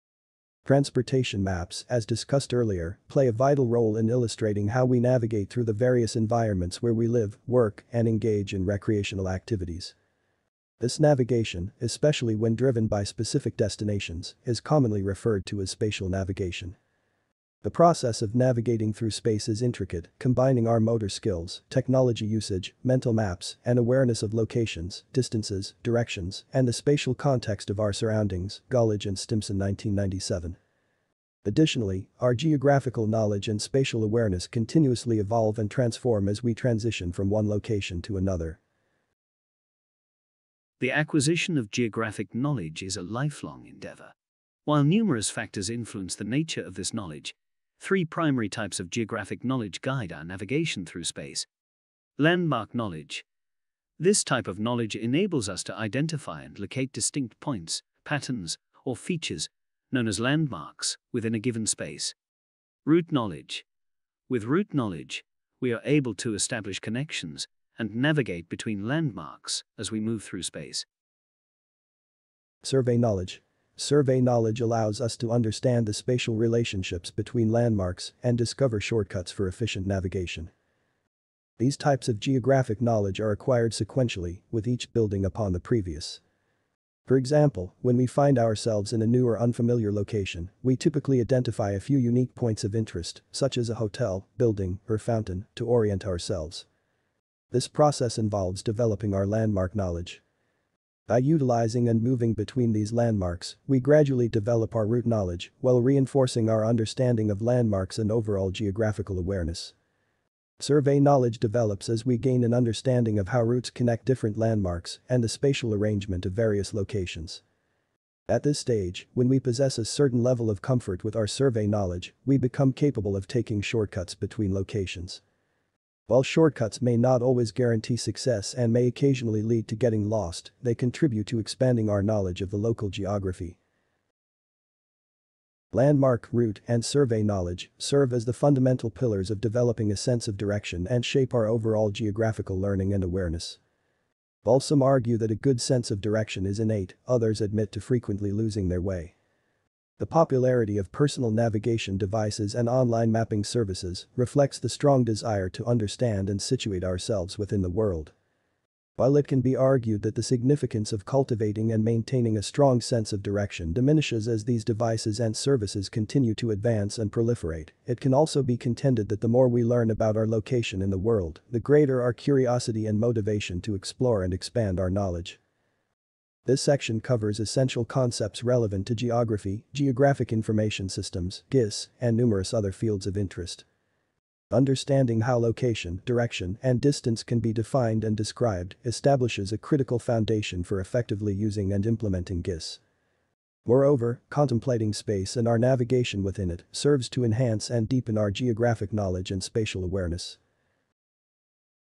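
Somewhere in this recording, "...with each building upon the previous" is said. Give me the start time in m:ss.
1:24.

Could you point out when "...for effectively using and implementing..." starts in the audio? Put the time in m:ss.
3:10.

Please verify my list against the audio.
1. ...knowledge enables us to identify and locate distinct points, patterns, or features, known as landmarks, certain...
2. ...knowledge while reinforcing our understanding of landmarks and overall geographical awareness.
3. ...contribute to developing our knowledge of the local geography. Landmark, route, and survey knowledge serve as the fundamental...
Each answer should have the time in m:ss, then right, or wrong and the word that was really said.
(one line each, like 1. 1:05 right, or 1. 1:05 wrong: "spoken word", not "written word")
1. 0:54 wrong: "within", not "certain"
2. 1:45 right
3. 2:10 wrong: "expanding", not "developing".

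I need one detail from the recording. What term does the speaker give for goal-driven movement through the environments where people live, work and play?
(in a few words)
spatial navigation.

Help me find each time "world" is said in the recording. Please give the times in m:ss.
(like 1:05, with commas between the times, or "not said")
2:37, 2:51.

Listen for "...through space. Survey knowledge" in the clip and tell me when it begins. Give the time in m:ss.
1:10.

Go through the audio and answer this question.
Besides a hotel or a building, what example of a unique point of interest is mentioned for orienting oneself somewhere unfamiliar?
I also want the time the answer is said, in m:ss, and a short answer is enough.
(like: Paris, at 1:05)
fountain, at 1:34.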